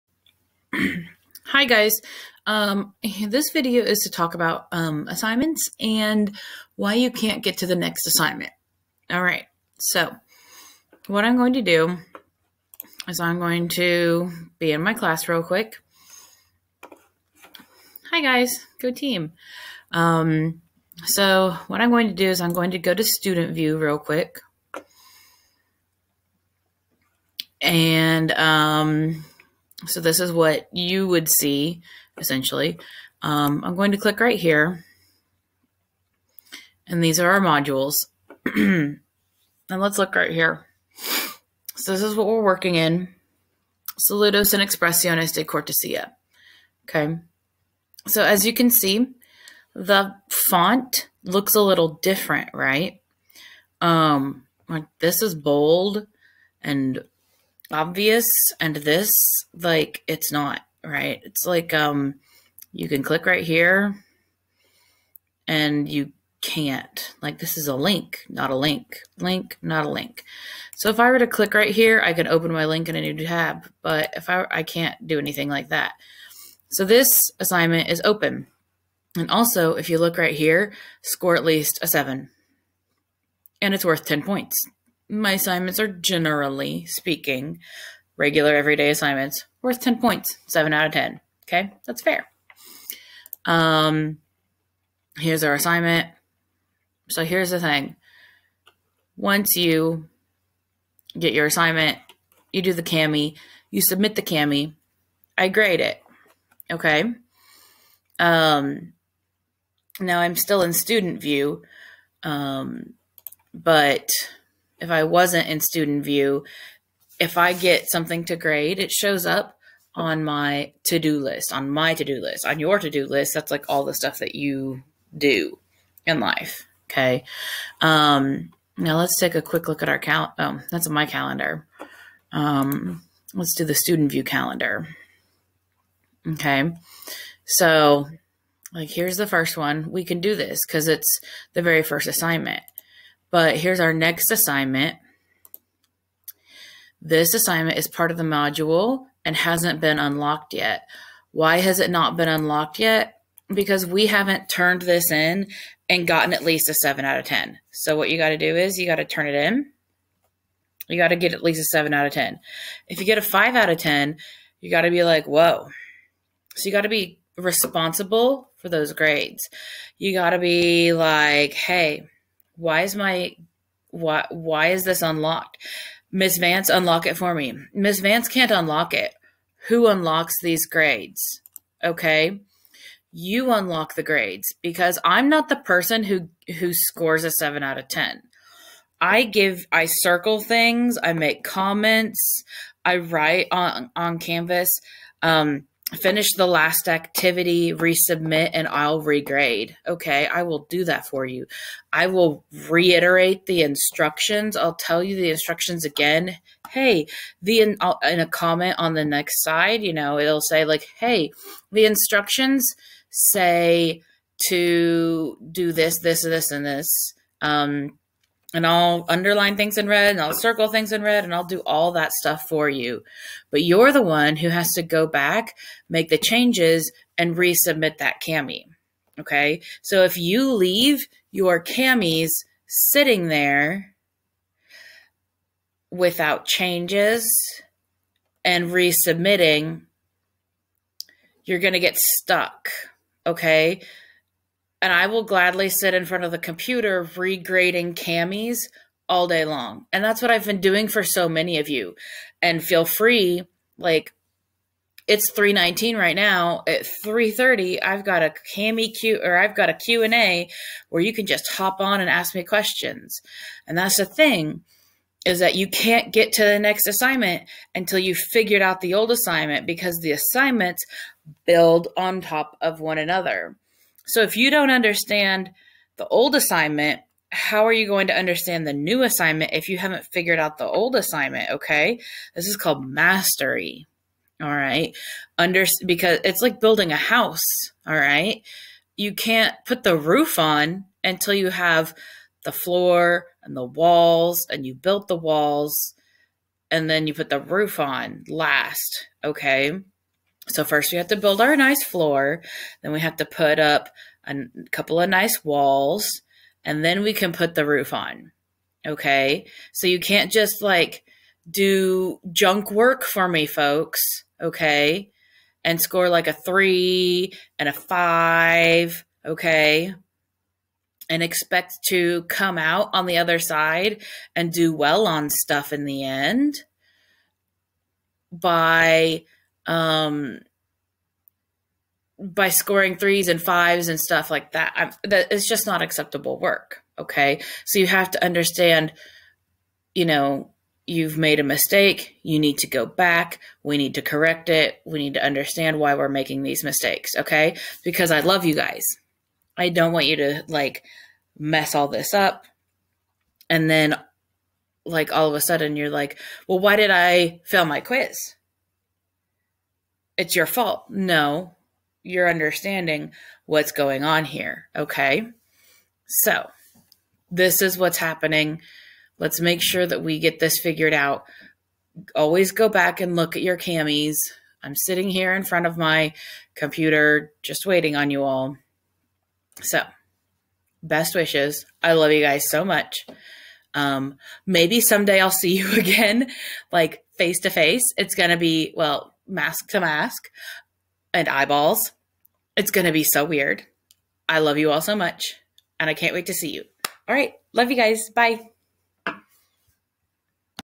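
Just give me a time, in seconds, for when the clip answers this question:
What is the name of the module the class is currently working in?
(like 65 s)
43 s.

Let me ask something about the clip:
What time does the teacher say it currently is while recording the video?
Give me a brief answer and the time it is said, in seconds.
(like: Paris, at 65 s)
3:19, at 255 s.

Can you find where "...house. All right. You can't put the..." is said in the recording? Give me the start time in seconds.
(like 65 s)
286 s.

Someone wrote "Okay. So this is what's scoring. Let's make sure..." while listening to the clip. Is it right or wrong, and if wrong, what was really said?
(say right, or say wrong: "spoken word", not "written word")
wrong: "happening", not "scoring".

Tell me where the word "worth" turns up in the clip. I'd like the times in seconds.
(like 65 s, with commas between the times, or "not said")
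83 s, 89 s.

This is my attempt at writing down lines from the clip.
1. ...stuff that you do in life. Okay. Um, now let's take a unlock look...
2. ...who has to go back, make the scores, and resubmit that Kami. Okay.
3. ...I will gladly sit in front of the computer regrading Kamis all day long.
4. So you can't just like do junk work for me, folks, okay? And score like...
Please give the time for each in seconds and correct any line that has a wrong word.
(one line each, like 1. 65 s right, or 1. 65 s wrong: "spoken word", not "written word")
1. 123 s wrong: "quick", not "unlock"
2. 224 s wrong: "changes", not "scores"
3. 244 s right
4. 309 s right.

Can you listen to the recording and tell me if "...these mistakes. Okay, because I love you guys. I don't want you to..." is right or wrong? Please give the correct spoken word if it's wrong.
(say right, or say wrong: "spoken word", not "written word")
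right.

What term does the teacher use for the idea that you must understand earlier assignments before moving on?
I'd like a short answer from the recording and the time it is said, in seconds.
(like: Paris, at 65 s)
Mastery, at 282 s.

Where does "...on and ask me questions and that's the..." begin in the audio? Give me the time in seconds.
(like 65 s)
261 s.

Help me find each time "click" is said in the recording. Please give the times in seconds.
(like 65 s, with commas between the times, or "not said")
33 s, 63 s, 71 s.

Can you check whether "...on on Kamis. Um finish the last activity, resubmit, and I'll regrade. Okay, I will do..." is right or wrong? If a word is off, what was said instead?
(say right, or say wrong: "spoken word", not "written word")
wrong: "Canvas", not "Kamis".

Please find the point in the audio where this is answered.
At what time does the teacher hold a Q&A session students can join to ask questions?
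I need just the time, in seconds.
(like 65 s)
256 s.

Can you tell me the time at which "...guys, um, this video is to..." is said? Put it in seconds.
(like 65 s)
1 s.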